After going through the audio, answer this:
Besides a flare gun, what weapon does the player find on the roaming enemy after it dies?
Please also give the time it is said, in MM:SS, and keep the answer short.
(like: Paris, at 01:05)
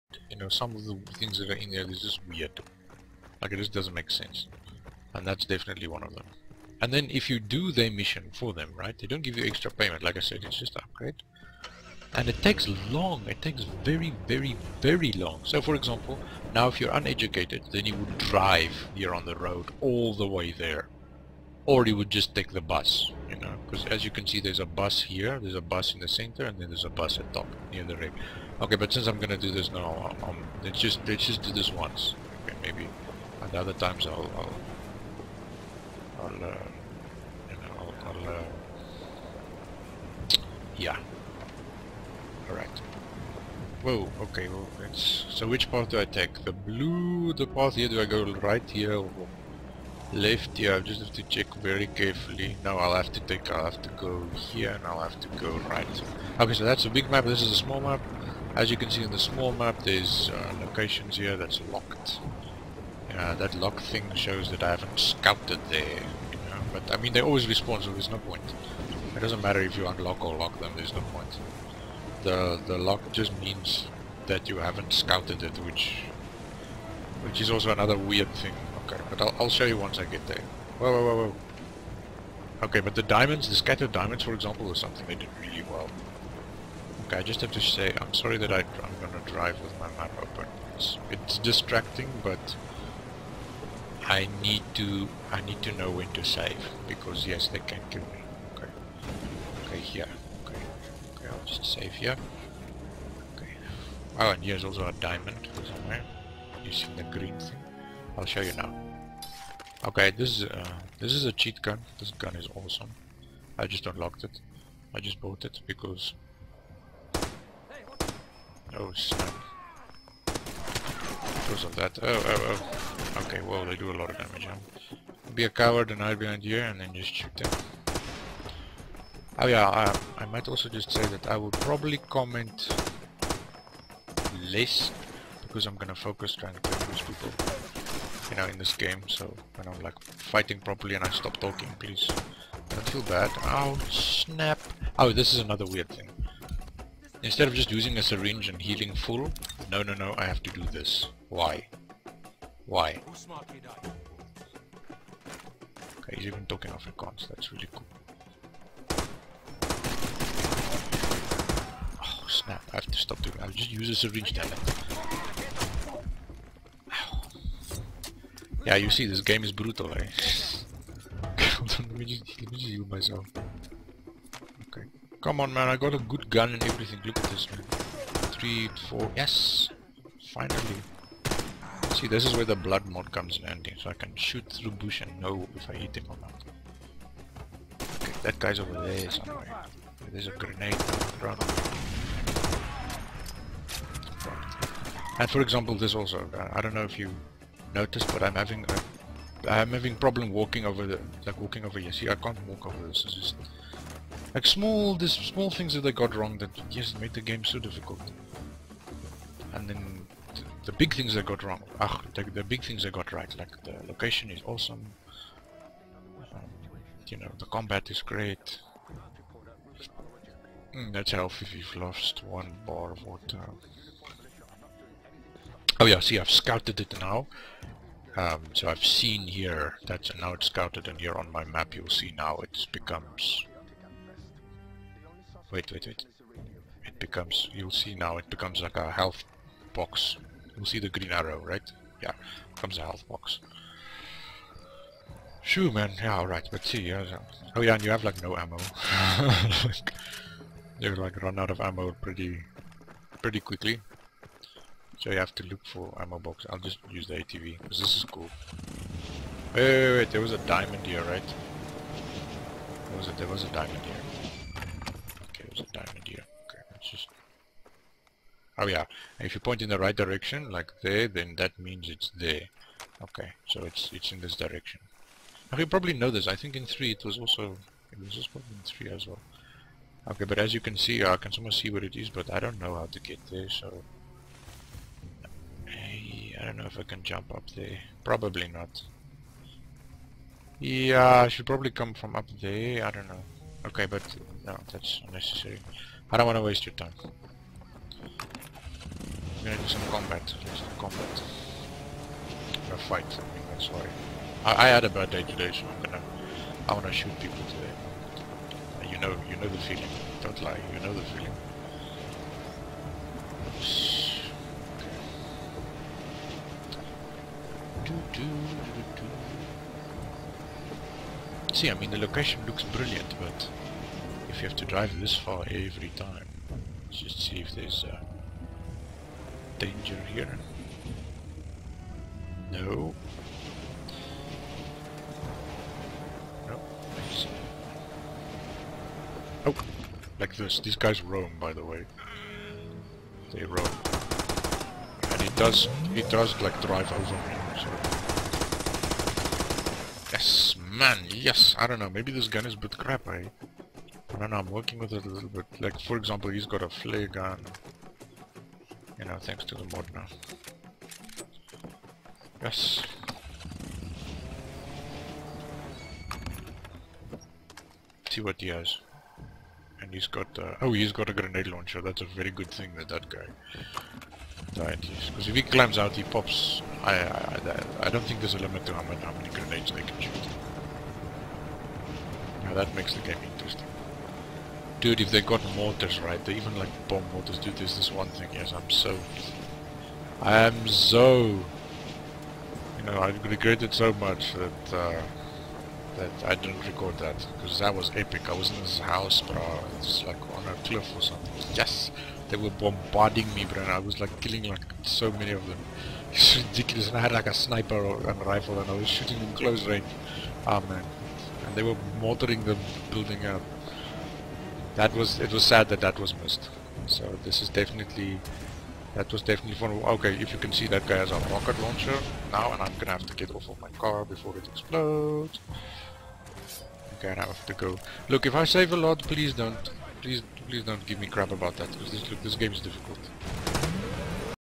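Grenade launcher, at 06:11.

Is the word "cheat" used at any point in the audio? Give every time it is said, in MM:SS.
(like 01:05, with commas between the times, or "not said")
01:51.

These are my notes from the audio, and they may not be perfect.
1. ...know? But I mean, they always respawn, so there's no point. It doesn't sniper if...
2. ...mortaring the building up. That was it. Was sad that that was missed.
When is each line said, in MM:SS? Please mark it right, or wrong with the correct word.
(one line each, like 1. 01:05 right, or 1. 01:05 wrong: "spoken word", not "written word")
1. 01:06 wrong: "matter", not "sniper"
2. 06:52 right.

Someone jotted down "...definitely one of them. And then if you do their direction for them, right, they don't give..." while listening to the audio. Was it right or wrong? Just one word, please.
wrong.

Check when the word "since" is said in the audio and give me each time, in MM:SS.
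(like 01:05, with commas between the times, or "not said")
00:28.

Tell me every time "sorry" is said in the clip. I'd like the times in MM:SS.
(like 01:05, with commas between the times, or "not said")
01:28, 05:03.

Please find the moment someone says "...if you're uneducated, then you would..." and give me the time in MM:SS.
00:16.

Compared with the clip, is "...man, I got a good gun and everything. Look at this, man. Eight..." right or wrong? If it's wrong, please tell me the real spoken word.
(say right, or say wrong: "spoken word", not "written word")
wrong: "Three", not "Eight".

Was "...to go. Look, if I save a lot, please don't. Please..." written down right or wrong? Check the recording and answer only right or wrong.
right.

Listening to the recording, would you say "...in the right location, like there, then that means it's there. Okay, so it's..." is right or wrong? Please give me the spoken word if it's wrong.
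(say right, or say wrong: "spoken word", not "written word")
wrong: "direction", not "location".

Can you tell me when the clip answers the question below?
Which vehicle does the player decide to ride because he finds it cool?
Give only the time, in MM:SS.
04:17.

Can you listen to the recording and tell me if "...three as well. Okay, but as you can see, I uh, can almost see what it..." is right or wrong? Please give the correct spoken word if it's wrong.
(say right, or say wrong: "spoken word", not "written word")
right.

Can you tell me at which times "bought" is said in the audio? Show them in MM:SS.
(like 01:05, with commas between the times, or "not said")
01:55.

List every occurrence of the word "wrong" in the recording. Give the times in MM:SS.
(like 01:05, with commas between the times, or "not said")
03:26, 03:31.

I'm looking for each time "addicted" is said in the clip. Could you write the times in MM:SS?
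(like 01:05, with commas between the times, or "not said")
not said.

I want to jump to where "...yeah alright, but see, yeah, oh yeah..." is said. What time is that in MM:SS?
04:05.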